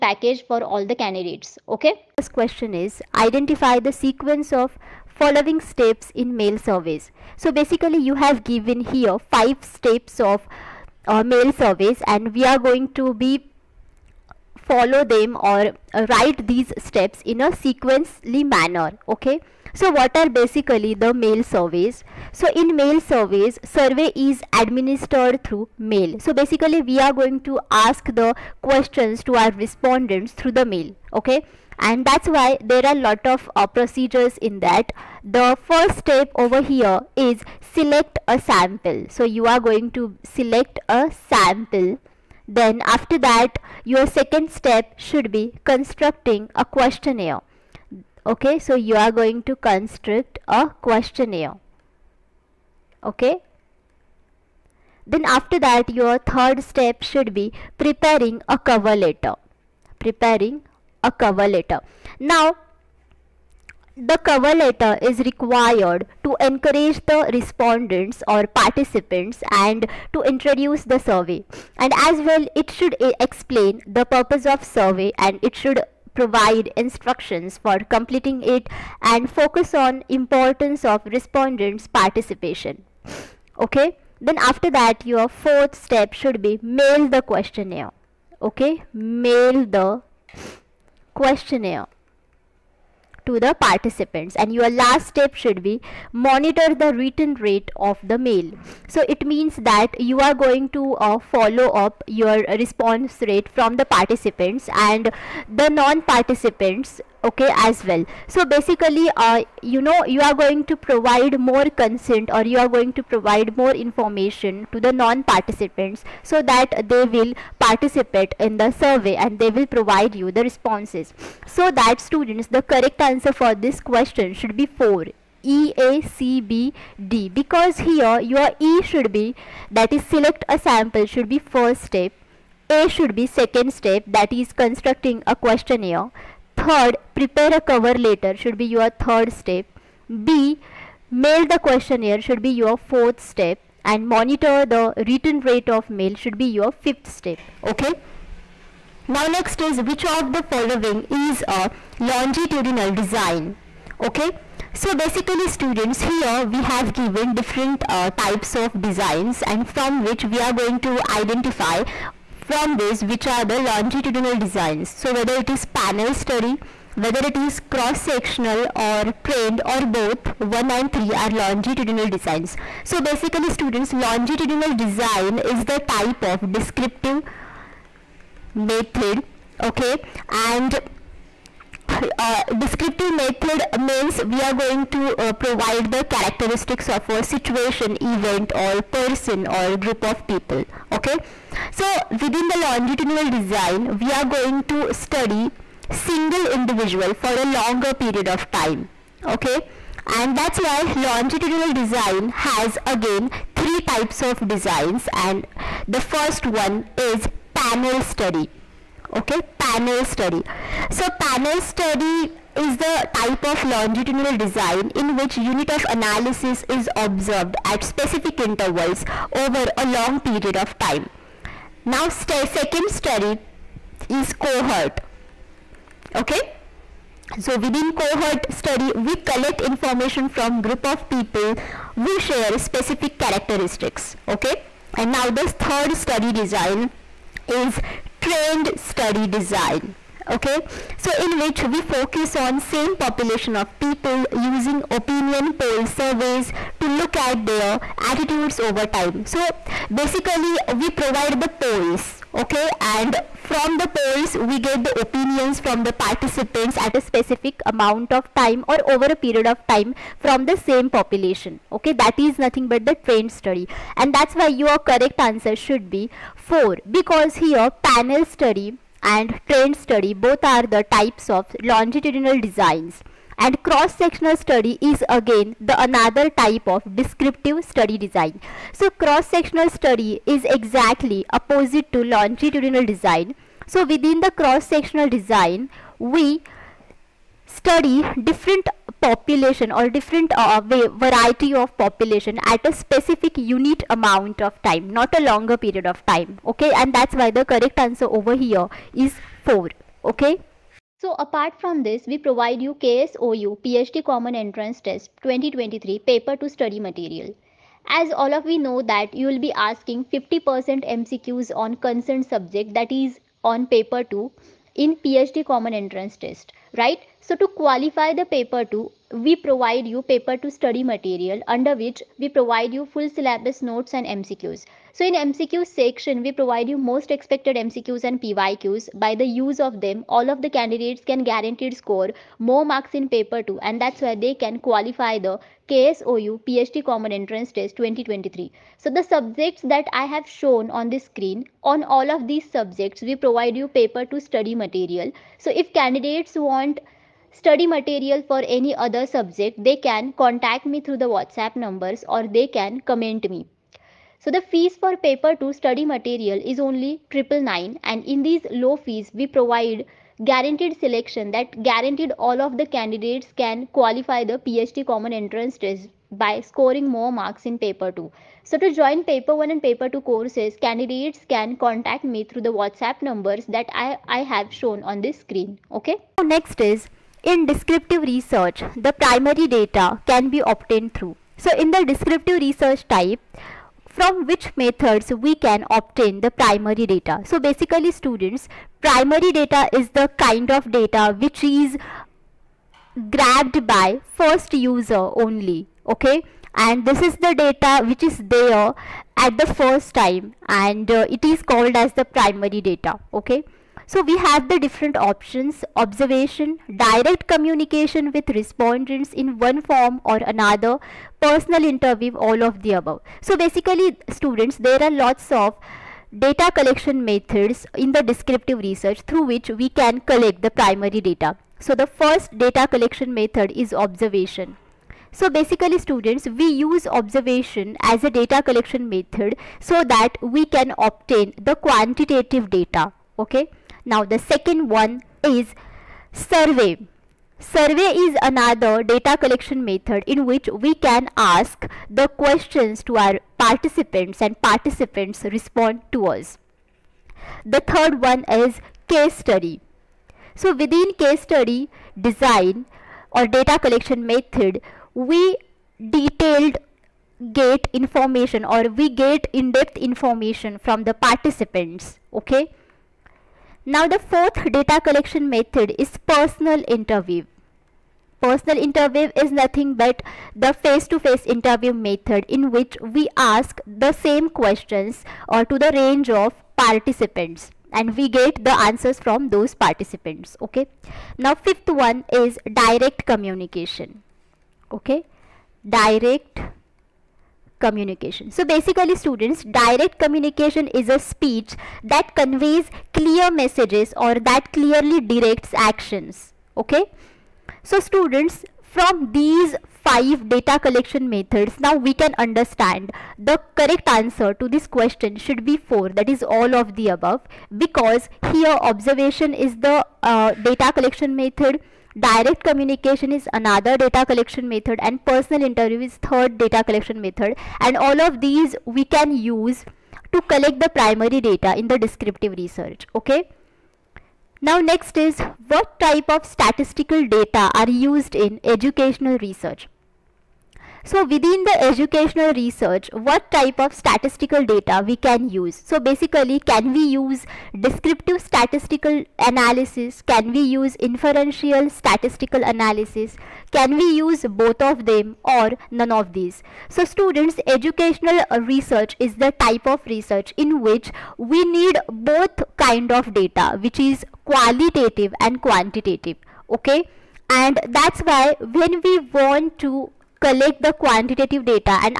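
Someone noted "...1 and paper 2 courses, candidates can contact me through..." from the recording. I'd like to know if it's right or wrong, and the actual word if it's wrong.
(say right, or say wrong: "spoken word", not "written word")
right.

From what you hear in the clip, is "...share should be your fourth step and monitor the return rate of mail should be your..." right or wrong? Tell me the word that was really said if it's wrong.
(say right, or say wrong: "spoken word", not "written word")
wrong: "questionnaire", not "share".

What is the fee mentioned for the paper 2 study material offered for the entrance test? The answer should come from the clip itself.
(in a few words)
999.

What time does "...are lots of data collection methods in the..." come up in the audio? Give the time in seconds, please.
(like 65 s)
414 s.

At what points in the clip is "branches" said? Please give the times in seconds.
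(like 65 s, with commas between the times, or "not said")
not said.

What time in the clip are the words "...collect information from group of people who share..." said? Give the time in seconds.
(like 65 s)
229 s.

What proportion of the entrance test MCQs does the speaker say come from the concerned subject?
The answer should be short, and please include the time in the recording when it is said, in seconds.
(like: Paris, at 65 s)
50%, at 310 s.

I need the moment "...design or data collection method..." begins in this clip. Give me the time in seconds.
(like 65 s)
451 s.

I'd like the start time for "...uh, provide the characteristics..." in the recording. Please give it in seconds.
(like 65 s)
185 s.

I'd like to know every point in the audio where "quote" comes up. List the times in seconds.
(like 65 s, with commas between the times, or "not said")
not said.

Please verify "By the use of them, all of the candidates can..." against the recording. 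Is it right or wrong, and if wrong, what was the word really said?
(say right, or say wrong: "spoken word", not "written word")
right.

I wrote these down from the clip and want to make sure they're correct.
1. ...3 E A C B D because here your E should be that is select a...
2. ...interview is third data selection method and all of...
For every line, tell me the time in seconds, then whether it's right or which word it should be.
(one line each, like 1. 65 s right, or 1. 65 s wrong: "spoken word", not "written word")
1. 124 s wrong: "4", not "3"
2. 515 s wrong: "collection", not "selection".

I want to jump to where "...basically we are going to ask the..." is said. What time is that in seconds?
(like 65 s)
26 s.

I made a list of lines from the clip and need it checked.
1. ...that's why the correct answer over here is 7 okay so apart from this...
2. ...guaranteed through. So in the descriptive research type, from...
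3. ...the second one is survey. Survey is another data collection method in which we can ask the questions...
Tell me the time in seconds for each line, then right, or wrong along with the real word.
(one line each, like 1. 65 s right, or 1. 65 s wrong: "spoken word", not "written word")
1. 296 s wrong: "4", not "7"
2. 380 s wrong: "obtained", not "guaranteed"
3. 434 s right.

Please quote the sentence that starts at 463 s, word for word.
Now the fourth data collection method is personal interview.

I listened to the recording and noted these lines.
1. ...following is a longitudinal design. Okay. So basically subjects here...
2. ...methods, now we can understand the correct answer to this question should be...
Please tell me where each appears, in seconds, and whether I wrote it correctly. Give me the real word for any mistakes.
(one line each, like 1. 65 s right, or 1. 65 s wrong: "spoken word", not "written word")
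1. 150 s wrong: "students", not "subjects"
2. 501 s right.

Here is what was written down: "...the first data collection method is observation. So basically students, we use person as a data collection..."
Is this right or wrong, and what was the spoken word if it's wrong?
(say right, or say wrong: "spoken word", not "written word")
wrong: "observation", not "person".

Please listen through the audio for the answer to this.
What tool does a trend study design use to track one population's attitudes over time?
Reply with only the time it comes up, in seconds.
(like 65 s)
244 s.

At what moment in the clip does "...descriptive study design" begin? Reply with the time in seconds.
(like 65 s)
276 s.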